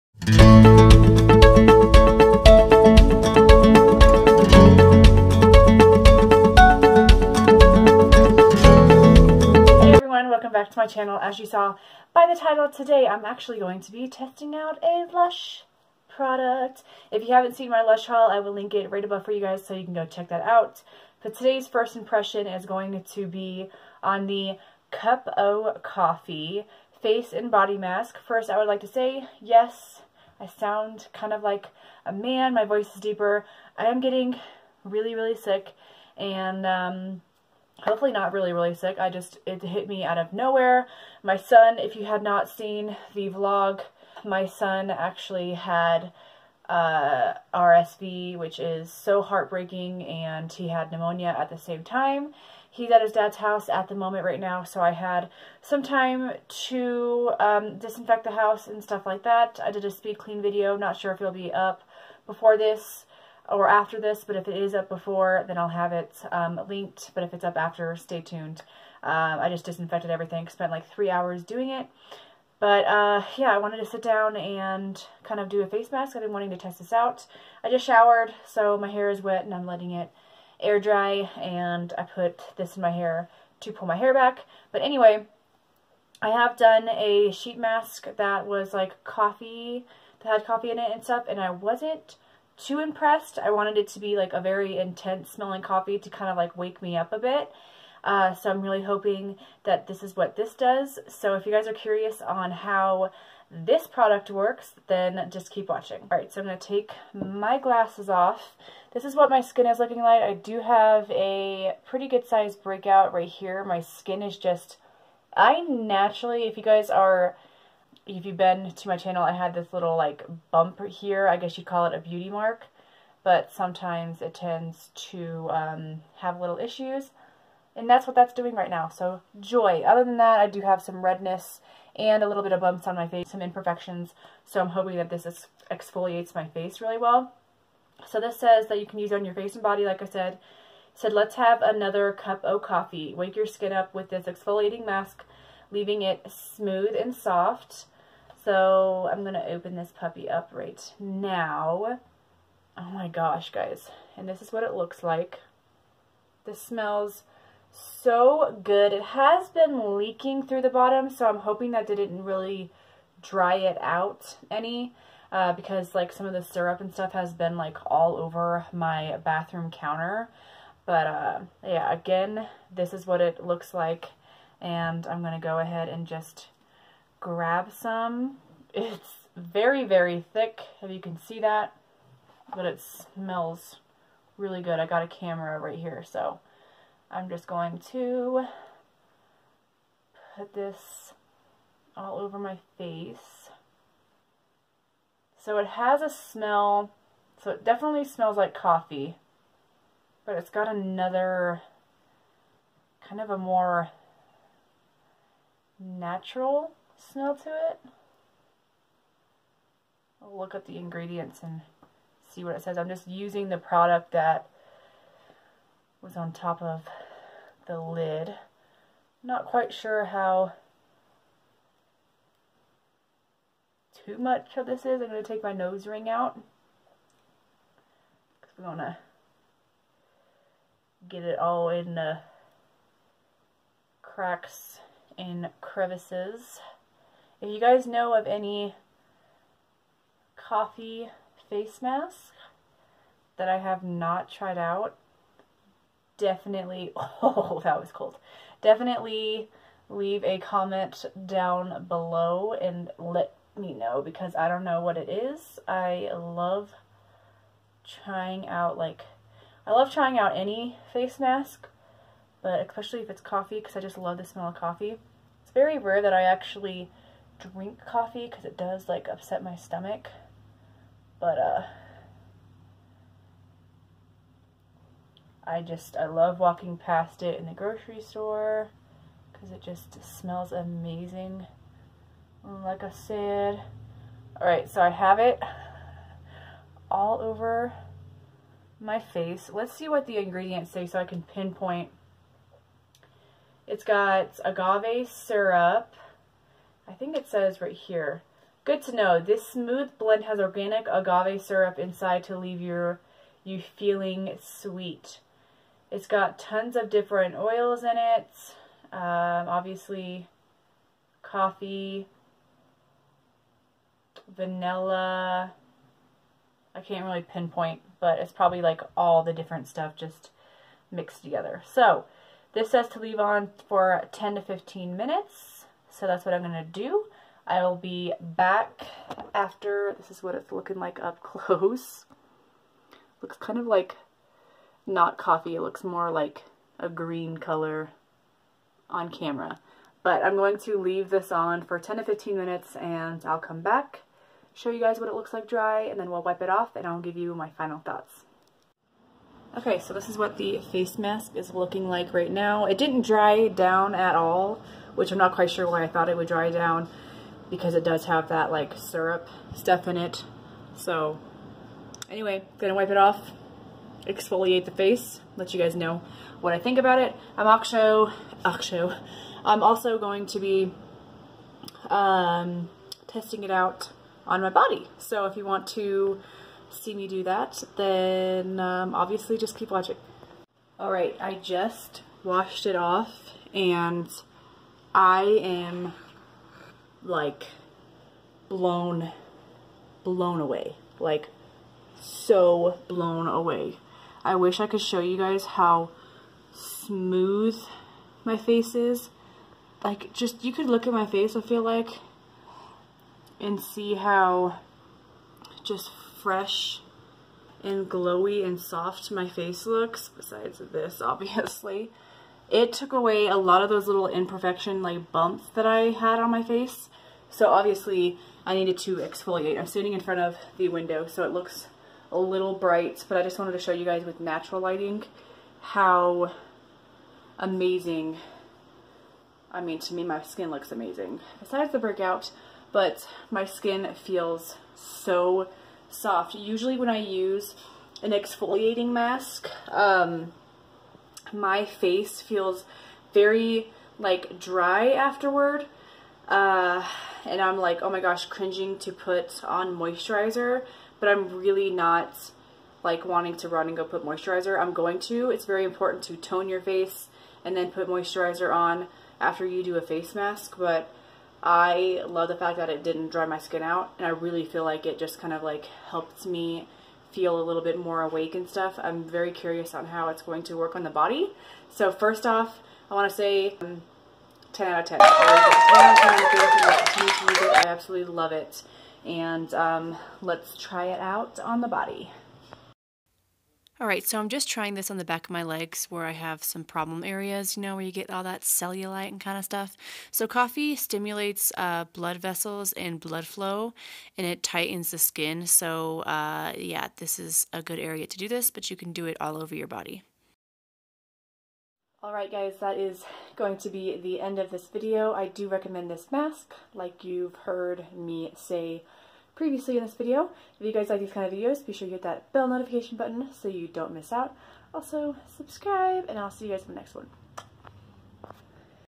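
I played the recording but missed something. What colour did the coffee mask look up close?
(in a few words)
Green.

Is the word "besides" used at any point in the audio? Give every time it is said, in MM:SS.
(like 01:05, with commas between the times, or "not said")
06:50, 07:11.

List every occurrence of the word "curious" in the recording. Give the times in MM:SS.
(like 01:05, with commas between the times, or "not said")
01:41, 07:49.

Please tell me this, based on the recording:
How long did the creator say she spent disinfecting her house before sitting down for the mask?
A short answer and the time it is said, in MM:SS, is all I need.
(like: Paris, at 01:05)
3 hours, at 01:10.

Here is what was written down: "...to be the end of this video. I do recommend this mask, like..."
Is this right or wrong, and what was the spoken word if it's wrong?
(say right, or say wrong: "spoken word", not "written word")
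right.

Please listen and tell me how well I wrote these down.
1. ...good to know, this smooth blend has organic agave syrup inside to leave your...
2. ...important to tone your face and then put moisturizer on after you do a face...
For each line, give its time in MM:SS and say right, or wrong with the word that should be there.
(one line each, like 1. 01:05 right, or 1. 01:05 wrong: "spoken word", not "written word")
1. 04:58 right
2. 07:35 right.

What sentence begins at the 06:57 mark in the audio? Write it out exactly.
So obviously I needed to exfoliate.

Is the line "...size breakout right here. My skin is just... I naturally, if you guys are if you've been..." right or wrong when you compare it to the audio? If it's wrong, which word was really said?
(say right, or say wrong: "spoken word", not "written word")
right.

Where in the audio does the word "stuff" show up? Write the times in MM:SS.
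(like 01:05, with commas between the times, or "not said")
00:58, 01:31, 02:46, 05:19, 05:59, 07:48, 08:09.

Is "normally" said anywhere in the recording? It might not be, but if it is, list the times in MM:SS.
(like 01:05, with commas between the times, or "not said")
not said.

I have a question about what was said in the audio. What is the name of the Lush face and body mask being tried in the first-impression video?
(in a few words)
Cup O Coffee.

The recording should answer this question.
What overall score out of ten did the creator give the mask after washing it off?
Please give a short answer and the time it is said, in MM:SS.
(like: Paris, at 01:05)
10 out of 10, at 07:54.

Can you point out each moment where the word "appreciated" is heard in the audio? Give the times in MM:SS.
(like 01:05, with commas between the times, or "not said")
not said.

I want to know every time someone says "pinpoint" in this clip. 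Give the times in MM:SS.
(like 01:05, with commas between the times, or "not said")
04:51, 05:17.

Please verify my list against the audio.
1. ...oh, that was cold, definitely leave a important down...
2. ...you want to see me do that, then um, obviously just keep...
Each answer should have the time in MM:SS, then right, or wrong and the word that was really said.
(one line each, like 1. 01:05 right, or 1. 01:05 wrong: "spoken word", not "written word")
1. 04:06 wrong: "comment", not "important"
2. 06:15 right.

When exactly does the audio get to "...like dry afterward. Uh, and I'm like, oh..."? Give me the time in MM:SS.
07:23.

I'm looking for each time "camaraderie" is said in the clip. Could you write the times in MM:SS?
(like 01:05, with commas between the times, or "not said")
not said.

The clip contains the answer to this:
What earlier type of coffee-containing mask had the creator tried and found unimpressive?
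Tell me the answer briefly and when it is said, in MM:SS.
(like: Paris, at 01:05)
Sheet mask, at 01:27.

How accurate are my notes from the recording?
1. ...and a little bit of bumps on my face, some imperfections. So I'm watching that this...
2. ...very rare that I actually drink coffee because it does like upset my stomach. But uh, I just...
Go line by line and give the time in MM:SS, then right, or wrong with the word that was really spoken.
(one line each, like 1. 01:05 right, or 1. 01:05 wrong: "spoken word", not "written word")
1. 02:11 wrong: "hoping", not "watching"
2. 04:25 right.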